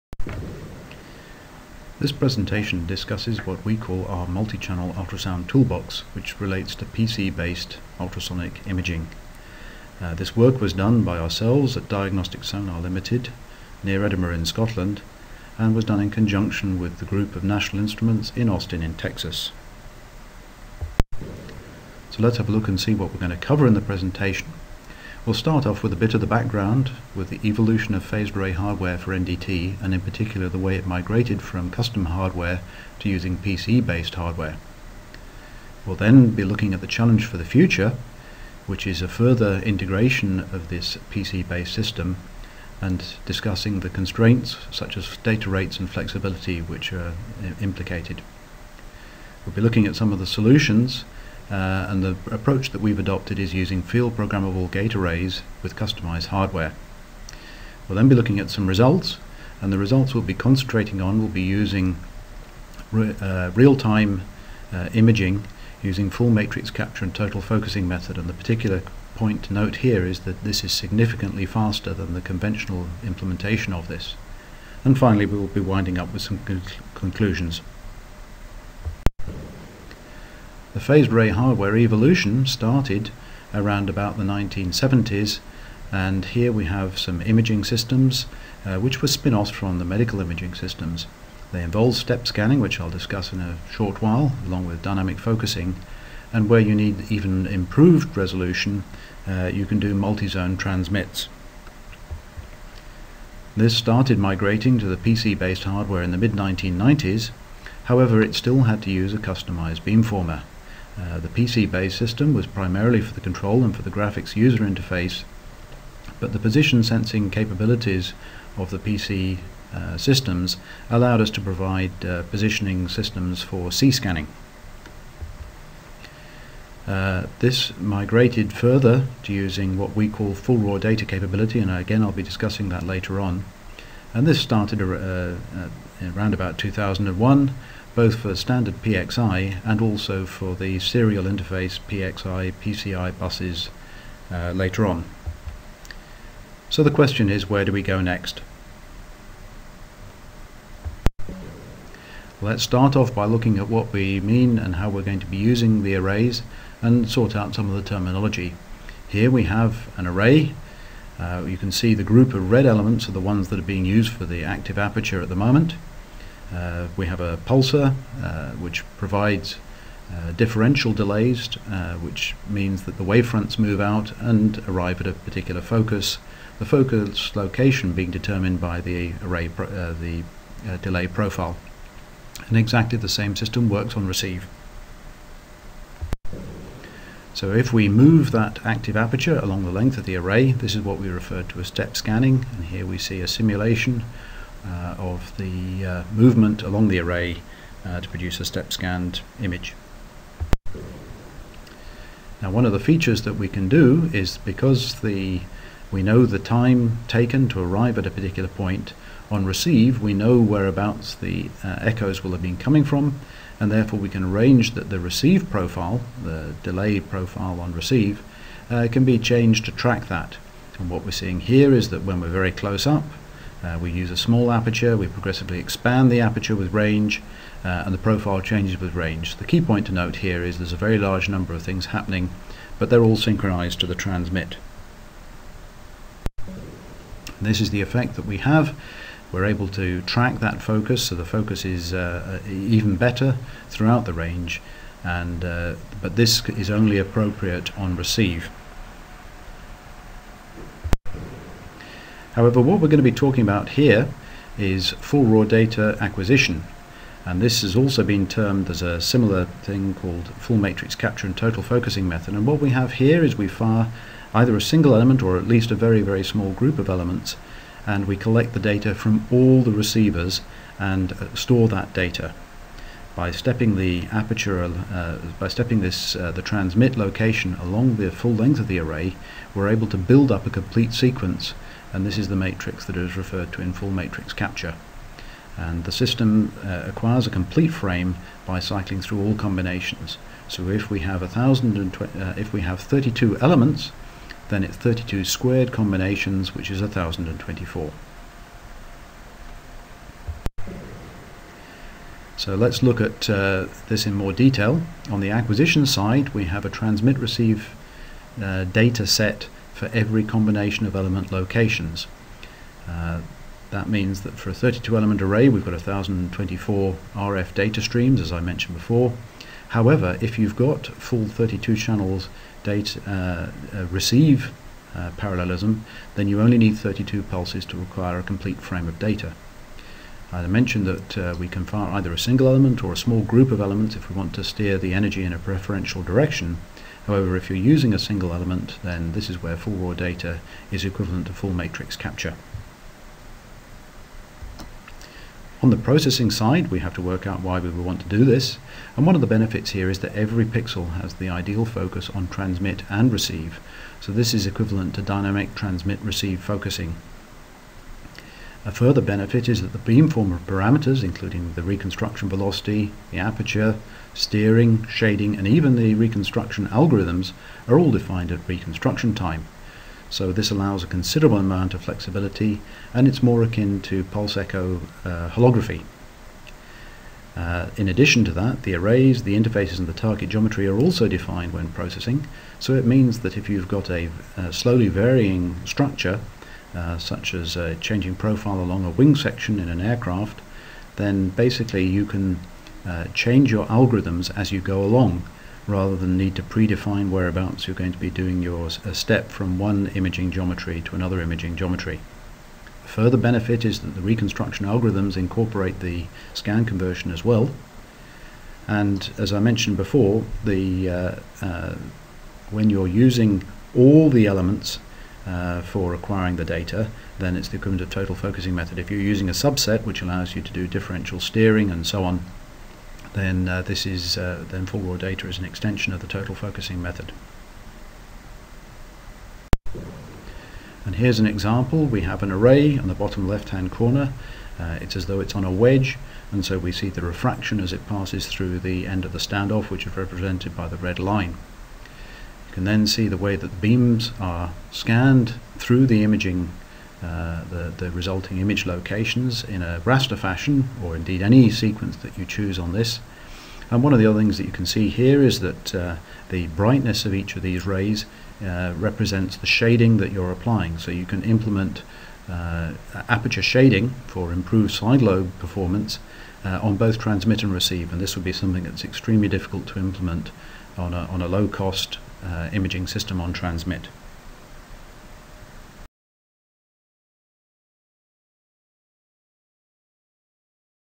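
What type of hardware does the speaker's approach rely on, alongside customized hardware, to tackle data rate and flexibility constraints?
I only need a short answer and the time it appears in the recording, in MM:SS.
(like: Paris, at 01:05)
field programmable gate arrays, at 00:53.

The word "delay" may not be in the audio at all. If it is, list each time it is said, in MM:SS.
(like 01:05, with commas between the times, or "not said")
02:50, 03:00, 03:36.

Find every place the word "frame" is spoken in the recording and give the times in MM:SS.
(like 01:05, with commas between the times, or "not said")
04:47, 05:28.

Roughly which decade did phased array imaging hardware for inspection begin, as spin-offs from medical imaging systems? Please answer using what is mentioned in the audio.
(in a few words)
1970s.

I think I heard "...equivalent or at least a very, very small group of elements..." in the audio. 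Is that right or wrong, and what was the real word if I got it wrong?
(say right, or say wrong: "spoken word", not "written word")
wrong: "element", not "equivalent".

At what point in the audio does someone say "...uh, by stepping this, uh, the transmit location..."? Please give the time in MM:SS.
04:34.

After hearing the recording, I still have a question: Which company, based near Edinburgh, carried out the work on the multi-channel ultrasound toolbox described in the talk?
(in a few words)
Diagnostic Sonar Limited.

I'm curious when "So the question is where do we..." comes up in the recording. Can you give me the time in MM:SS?
02:26.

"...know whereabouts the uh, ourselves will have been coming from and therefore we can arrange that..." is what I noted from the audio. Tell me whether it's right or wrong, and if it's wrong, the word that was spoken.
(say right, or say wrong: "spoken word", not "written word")
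wrong: "echoes", not "ourselves".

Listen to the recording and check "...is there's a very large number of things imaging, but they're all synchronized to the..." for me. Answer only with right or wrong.
wrong.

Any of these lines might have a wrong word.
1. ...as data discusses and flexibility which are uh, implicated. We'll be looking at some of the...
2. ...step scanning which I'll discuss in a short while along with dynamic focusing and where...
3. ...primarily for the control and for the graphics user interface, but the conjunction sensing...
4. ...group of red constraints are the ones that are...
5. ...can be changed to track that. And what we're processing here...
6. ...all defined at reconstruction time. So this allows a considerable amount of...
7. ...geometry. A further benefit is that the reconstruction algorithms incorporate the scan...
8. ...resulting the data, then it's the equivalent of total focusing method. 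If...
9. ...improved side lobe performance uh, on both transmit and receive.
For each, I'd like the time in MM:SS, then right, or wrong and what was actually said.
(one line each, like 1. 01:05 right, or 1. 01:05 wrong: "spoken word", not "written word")
1. 00:44 wrong: "rates", not "discusses"
2. 01:31 right
3. 01:52 wrong: "position", not "conjunction"
4. 02:42 wrong: "elements", not "constraints"
5. 03:38 wrong: "seeing", not "processing"
6. 06:07 right
7. 06:41 right
8. 06:55 wrong: "acquiring", not "resulting"
9. 07:44 right.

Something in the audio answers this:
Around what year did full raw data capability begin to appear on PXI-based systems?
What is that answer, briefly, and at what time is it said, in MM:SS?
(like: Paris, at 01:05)
2001, at 02:16.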